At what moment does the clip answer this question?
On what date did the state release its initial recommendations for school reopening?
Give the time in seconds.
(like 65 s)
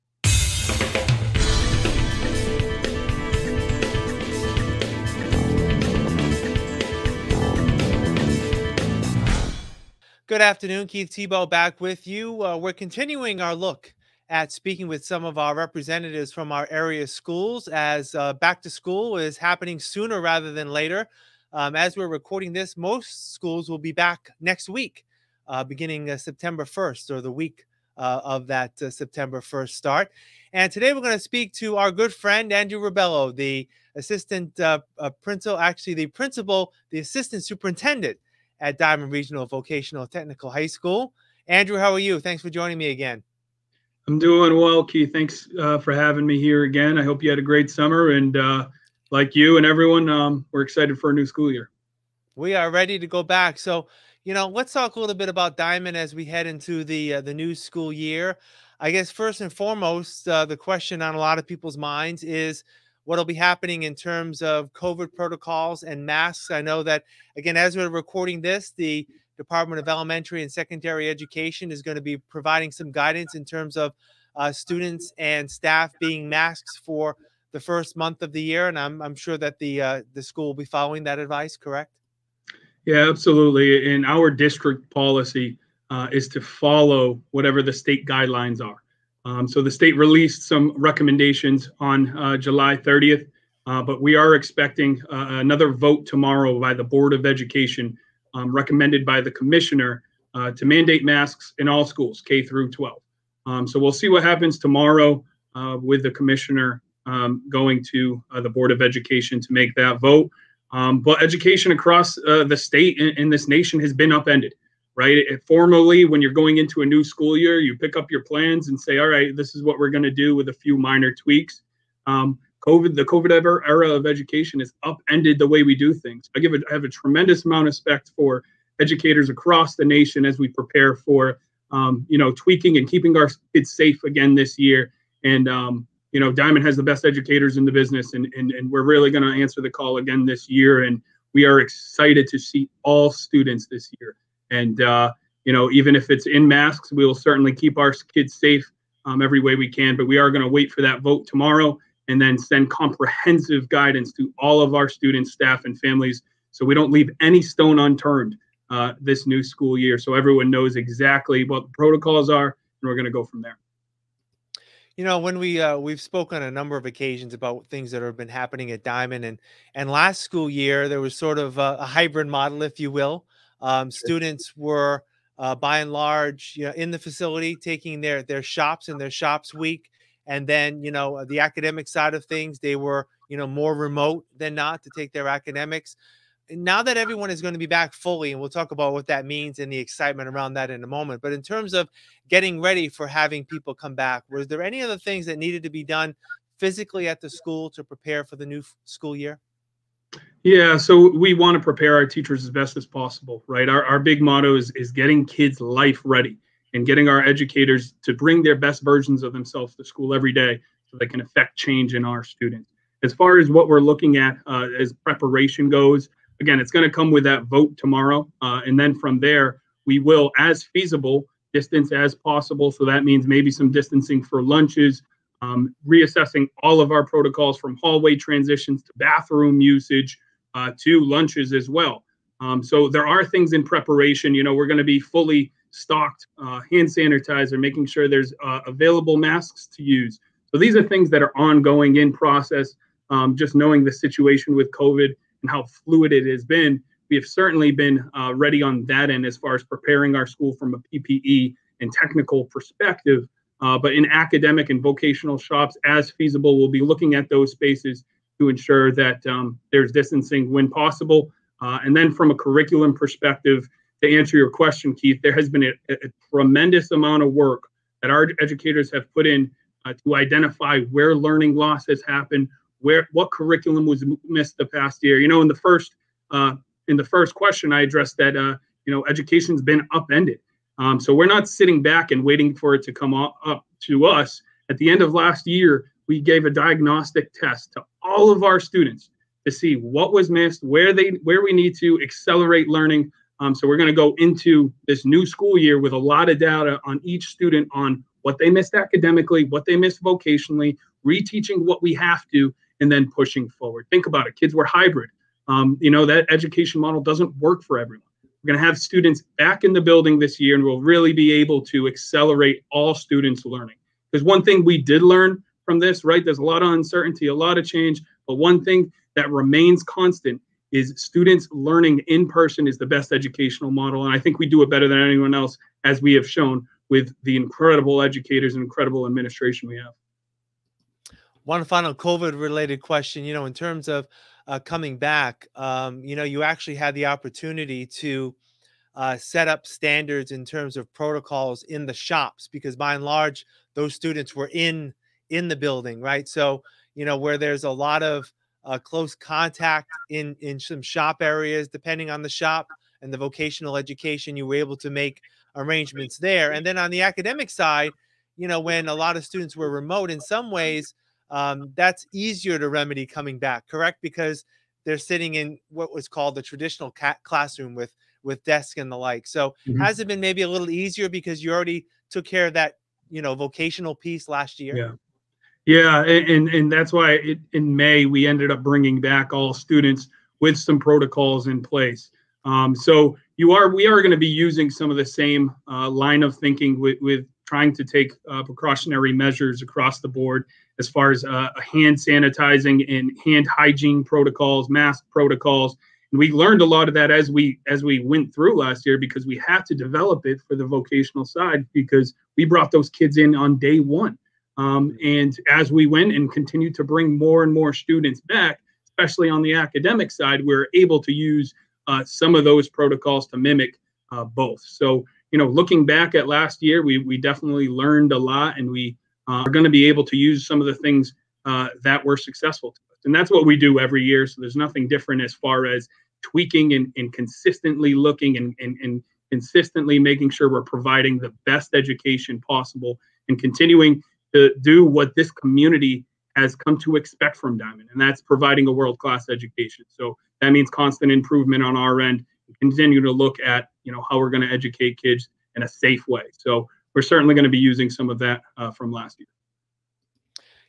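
92 s.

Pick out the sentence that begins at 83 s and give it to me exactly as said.
And our district policy uh, is to follow whatever the state guidelines are.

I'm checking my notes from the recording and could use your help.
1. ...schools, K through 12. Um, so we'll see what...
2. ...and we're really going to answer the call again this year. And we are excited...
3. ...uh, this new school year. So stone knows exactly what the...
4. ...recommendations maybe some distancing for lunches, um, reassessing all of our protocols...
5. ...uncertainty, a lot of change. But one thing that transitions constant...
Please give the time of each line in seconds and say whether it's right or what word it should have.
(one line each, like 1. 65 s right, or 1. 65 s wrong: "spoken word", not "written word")
1. 101 s right
2. 138 s right
3. 158 s wrong: "everyone", not "stone"
4. 223 s wrong: "means", not "recommendations"
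5. 316 s wrong: "remains", not "transitions".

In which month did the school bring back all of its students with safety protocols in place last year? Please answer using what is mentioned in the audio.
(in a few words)
May.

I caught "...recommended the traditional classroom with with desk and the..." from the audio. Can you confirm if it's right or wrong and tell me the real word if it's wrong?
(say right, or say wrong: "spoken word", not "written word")
wrong: "called", not "recommended".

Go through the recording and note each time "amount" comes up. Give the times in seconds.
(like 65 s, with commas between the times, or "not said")
127 s, 266 s.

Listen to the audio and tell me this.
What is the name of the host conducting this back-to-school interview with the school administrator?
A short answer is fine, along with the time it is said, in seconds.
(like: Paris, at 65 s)
Keith Tebow, at 10 s.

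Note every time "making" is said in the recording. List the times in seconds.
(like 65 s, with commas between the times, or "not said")
237 s, 429 s.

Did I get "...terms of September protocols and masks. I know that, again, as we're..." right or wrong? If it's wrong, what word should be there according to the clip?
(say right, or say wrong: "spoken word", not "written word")
wrong: "COVID", not "September".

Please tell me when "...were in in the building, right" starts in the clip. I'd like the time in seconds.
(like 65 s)
344 s.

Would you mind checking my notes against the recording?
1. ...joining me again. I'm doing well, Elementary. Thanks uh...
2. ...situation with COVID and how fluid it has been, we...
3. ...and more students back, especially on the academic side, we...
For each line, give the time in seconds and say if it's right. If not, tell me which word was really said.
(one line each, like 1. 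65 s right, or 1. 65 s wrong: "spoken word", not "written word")
1. 42 s wrong: "Keith", not "Elementary"
2. 243 s right
3. 407 s right.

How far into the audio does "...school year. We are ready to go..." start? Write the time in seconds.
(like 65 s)
51 s.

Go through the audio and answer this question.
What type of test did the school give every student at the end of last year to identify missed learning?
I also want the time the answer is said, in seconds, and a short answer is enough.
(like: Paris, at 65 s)
Diagnostic test, at 286 s.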